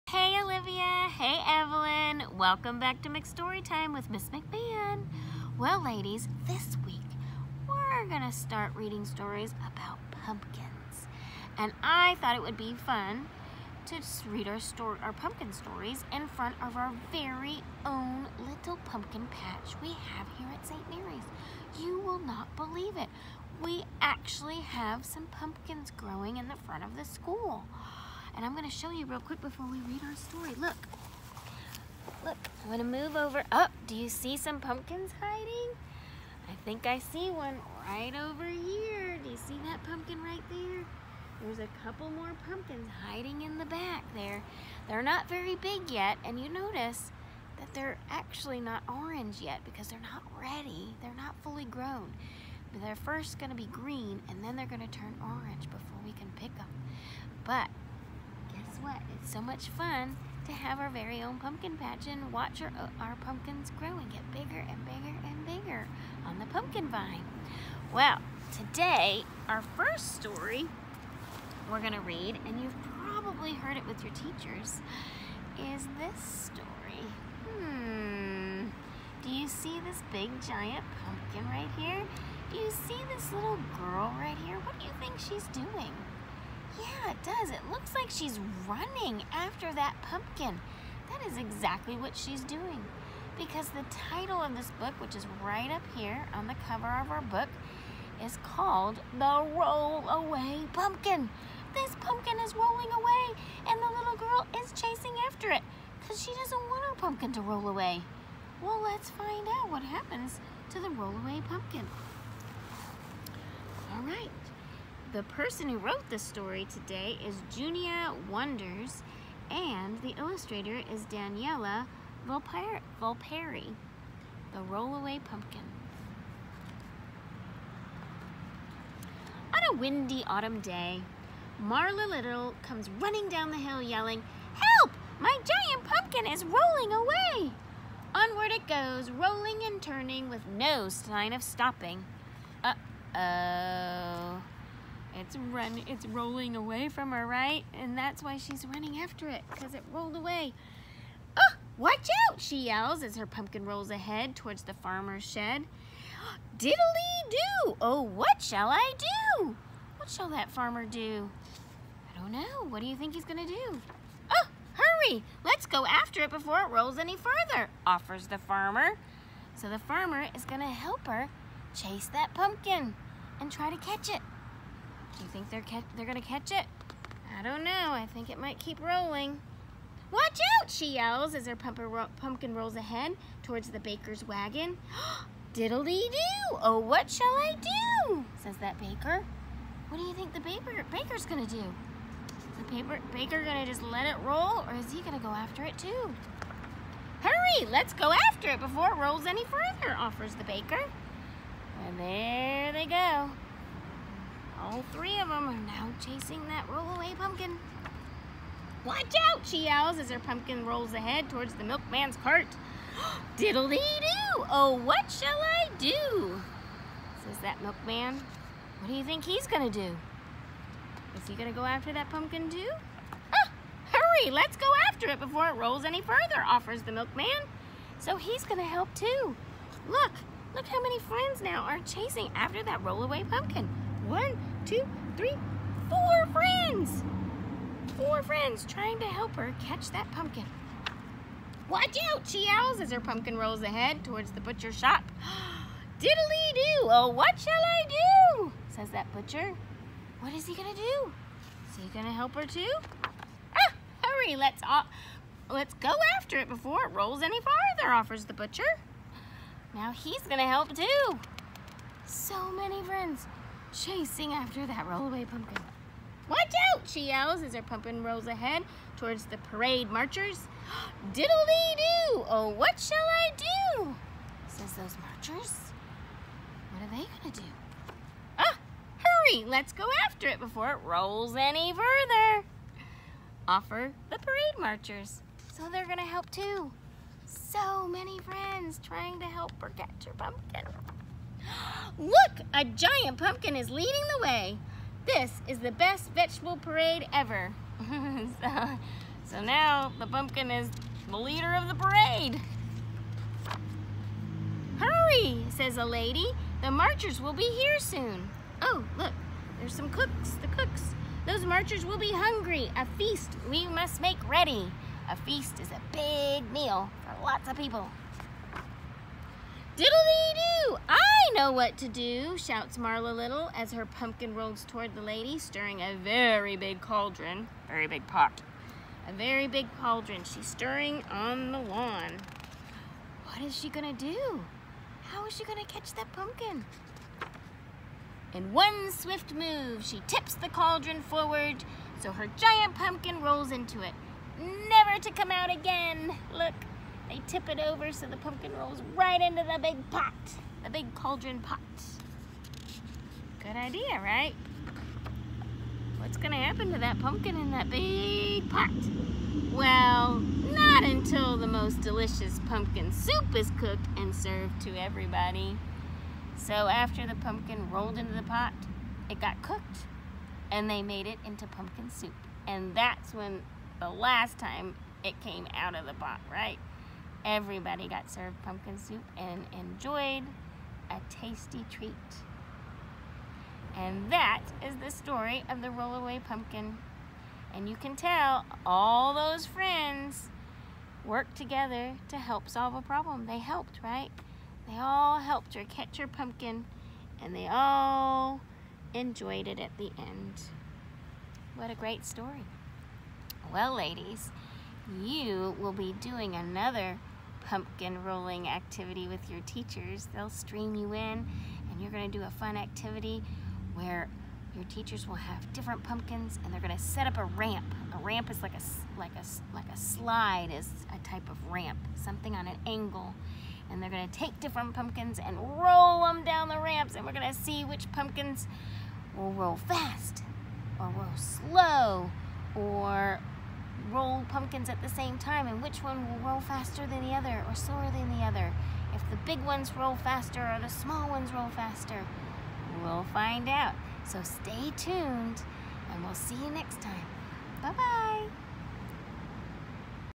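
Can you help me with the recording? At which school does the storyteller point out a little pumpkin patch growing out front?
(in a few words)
St. Mary's.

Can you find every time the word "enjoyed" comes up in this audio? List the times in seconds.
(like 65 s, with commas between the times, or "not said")
379 s, 398 s.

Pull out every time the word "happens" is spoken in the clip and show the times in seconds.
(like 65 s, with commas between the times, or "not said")
109 s, 356 s.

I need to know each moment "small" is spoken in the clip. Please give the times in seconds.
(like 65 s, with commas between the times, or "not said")
440 s.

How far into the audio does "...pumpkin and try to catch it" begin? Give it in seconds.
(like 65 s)
172 s.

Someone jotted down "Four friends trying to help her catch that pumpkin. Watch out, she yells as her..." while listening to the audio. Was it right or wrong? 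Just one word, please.
right.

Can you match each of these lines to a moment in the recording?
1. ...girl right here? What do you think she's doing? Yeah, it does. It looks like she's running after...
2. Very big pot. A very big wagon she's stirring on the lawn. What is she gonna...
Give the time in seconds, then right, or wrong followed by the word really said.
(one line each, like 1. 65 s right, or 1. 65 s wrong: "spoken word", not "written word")
1. 83 s right
2. 327 s wrong: "cauldron", not "wagon".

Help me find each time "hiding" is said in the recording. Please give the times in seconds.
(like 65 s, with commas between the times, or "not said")
35 s, 43 s.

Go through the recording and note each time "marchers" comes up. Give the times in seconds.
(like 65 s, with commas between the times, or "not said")
269 s, 275 s, 284 s, 306 s, 311 s.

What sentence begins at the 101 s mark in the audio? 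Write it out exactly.
This pumpkin is rolling away and the little girl is chasing after it because she doesn't want her pumpkin to roll away.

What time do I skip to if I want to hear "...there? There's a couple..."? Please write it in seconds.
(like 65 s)
40 s.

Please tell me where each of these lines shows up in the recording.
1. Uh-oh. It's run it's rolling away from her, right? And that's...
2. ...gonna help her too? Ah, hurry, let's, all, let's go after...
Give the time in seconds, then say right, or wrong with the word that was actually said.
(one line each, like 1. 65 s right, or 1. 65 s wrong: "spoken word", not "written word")
1. 142 s right
2. 251 s right.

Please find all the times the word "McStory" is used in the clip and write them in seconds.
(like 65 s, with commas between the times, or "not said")
3 s.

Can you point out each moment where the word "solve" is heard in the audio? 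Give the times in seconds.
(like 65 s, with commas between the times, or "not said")
392 s.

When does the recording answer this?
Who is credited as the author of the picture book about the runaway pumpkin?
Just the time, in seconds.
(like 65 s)
117 s.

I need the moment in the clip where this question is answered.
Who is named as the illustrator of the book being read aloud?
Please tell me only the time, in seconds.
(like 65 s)
121 s.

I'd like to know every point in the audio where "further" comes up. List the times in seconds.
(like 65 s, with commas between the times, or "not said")
167 s, 199 s, 226 s, 281 s.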